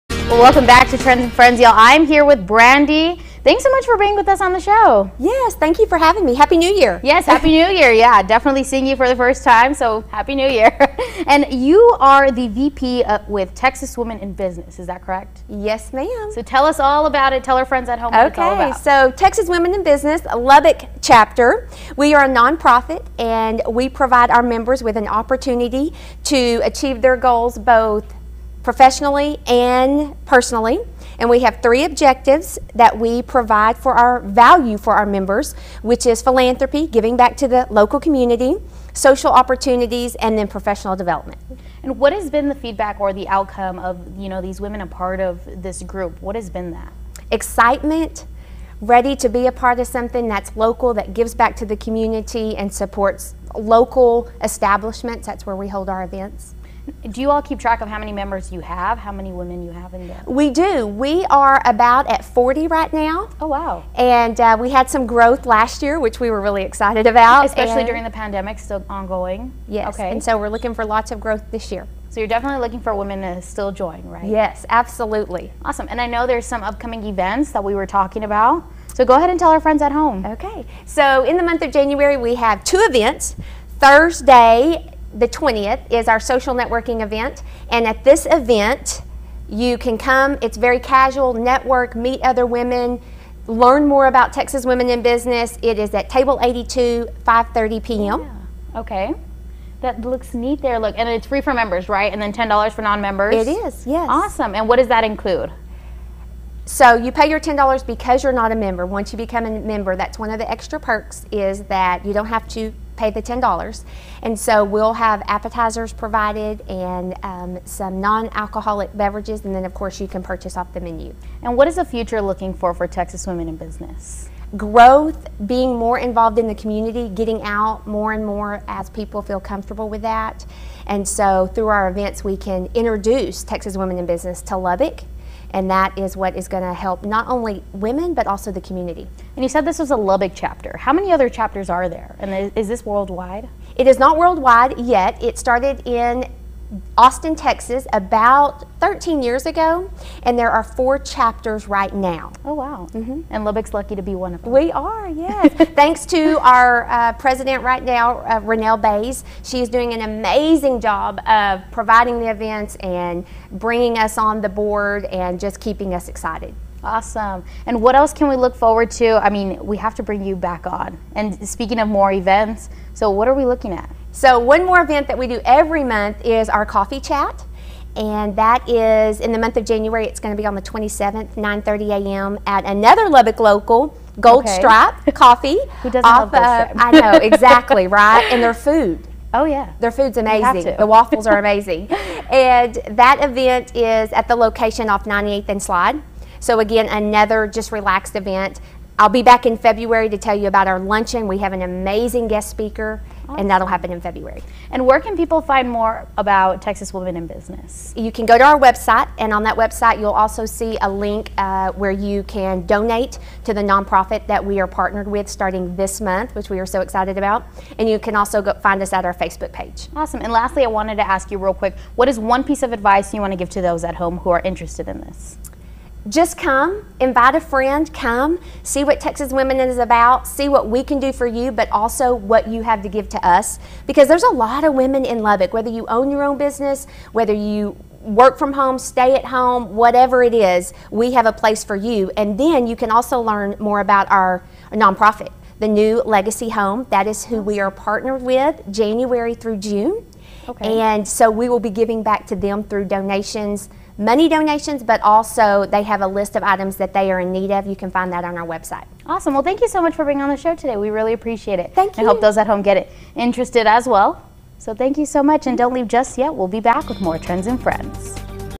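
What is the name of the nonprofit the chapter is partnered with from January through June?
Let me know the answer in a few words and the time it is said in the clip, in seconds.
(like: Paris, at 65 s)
New Legacy Home, at 245 s.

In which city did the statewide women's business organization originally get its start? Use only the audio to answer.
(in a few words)
Austin, Texas.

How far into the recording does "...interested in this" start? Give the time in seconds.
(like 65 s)
224 s.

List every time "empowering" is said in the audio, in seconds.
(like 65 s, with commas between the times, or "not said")
not said.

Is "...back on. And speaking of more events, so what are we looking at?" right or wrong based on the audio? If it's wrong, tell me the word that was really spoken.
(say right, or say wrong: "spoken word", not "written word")
right.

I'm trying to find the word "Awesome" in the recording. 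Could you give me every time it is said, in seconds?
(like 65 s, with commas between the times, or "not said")
75 s, 104 s, 166 s, 203 s, 219 s, 259 s.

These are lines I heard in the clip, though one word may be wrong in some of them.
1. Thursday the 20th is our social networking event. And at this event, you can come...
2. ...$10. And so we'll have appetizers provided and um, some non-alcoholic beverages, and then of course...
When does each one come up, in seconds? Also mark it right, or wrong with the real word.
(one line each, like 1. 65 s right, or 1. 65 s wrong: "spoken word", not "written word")
1. 83 s right
2. 113 s right.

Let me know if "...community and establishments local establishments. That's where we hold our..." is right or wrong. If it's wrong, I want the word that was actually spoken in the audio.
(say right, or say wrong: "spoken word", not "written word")
wrong: "supports", not "establishments".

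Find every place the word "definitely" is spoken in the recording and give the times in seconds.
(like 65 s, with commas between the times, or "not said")
8 s, 72 s.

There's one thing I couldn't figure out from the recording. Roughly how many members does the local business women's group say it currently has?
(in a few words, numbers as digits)
40.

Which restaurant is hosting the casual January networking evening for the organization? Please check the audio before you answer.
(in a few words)
Table 82.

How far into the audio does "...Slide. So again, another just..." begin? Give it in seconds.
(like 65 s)
195 s.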